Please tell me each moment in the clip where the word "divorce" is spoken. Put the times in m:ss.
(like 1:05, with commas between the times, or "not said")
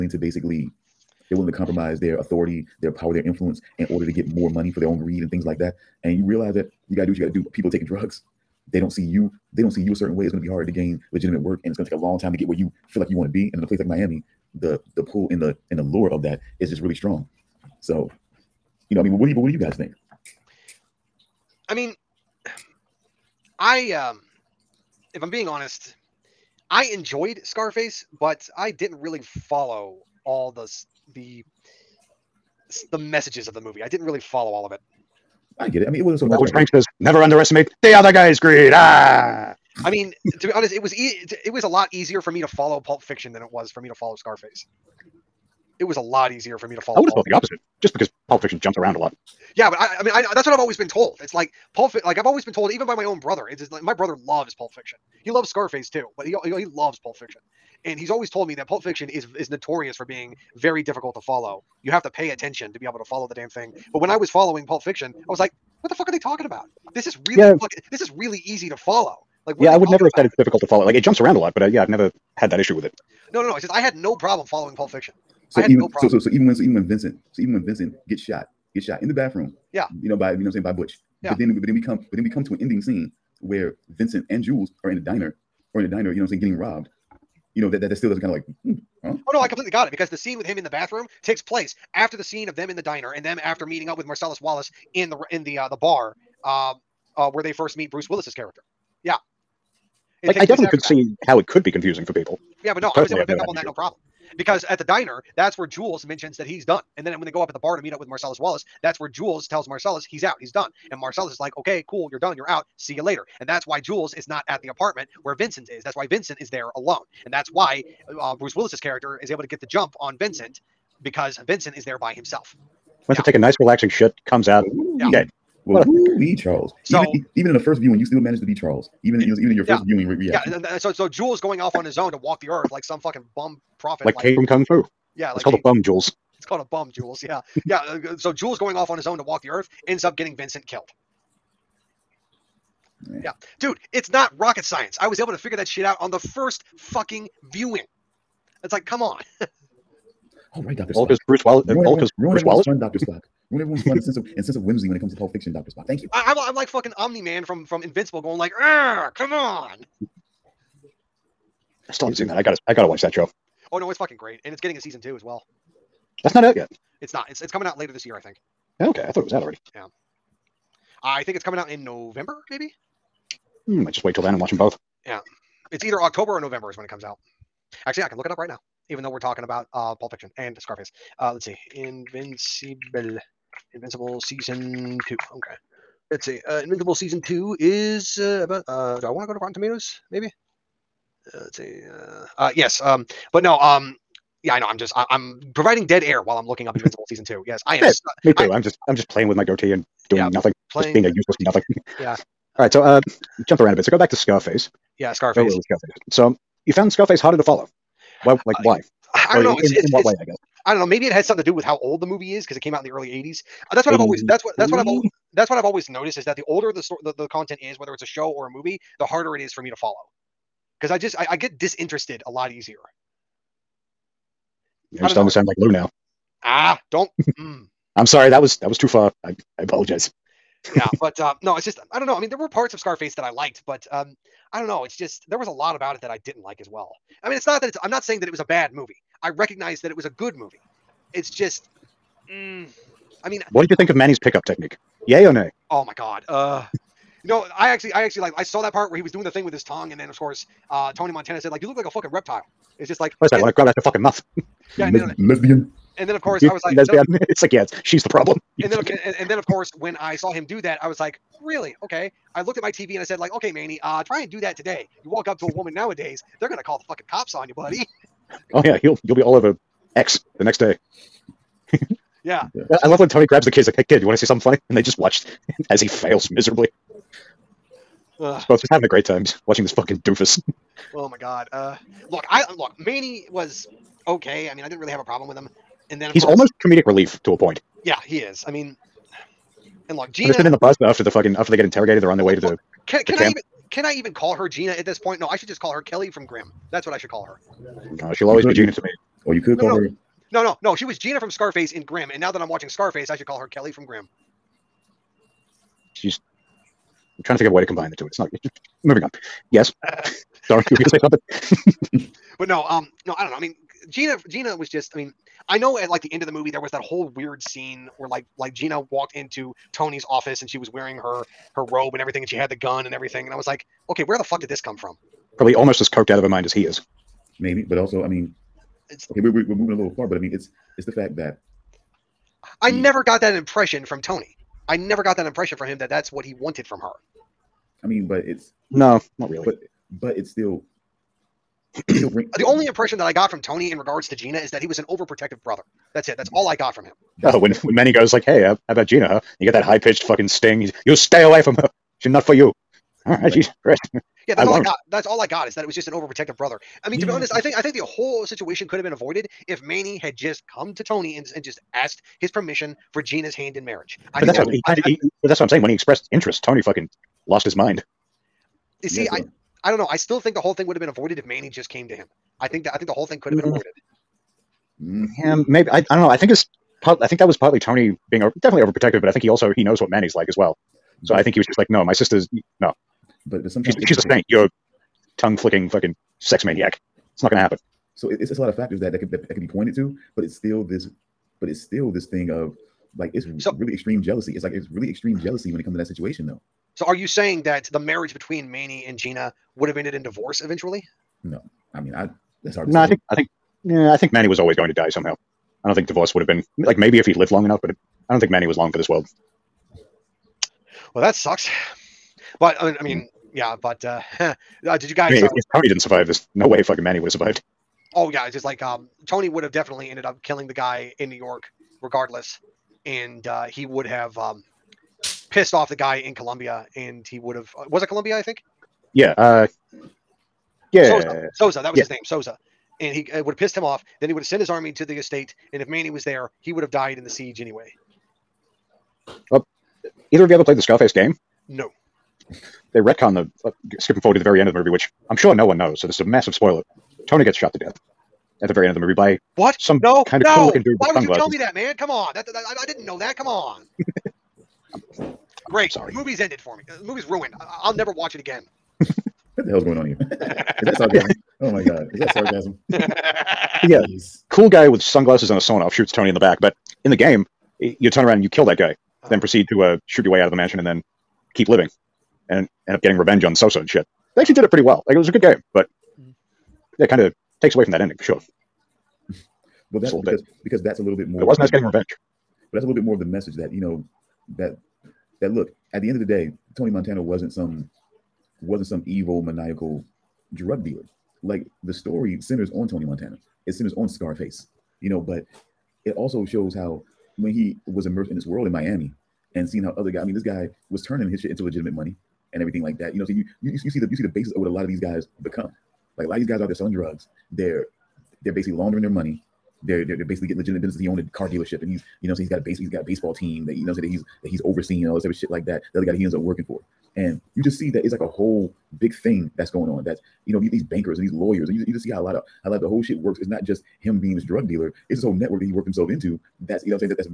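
6:40, 6:45.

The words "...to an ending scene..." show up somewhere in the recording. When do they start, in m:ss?
1:22.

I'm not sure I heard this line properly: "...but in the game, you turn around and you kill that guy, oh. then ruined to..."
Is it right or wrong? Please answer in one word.
wrong.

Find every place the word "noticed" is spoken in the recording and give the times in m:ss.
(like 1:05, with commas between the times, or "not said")
3:35.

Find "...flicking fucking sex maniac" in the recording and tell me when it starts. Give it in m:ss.
6:25.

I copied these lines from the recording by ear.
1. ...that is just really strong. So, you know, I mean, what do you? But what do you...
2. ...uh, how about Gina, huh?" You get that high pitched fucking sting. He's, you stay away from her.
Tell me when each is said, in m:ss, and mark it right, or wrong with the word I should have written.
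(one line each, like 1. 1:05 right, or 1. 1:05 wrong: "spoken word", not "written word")
1. 0:16 right
2. 5:48 right.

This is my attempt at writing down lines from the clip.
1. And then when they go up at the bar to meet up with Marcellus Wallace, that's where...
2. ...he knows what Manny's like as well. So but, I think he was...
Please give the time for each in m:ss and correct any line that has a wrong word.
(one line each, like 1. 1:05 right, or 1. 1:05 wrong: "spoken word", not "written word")
1. 1:46 right
2. 6:19 right.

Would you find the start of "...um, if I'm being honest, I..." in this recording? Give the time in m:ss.
0:23.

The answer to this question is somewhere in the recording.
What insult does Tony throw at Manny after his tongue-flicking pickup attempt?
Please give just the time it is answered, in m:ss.
4:12.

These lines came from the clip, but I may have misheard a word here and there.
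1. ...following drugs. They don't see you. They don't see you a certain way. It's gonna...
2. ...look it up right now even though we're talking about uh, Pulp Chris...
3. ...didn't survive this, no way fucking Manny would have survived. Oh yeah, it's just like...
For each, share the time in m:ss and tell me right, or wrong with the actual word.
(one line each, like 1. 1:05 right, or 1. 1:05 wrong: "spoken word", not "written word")
1. 0:07 wrong: "taking", not "following"
2. 2:58 wrong: "Fiction", not "Chris"
3. 6:55 right.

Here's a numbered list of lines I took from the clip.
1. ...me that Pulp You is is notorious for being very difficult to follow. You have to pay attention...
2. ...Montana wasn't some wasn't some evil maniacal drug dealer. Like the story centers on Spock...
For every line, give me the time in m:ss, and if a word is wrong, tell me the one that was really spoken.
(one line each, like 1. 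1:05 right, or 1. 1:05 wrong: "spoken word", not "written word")
1. 0:58 wrong: "Fiction", not "You"
2. 8:06 wrong: "Tony", not "Spock".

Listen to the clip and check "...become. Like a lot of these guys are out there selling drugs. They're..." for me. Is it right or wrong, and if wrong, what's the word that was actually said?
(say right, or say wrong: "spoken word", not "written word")
right.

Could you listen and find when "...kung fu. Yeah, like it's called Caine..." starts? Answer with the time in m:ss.
2:14.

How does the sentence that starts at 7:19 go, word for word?
Well, either of you ever played the Scarface game?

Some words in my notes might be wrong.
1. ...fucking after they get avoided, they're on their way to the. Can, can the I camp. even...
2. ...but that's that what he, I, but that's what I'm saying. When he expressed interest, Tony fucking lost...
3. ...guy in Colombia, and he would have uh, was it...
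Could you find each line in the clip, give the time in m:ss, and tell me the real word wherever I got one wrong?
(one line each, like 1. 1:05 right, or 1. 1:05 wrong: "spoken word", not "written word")
1. 4:51 wrong: "interrogated", not "avoided"
2. 6:04 right
3. 7:05 right.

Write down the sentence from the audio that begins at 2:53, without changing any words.
might hmm, just wait till then and watch them both.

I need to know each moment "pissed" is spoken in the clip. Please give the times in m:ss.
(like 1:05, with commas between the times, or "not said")
7:05, 7:13.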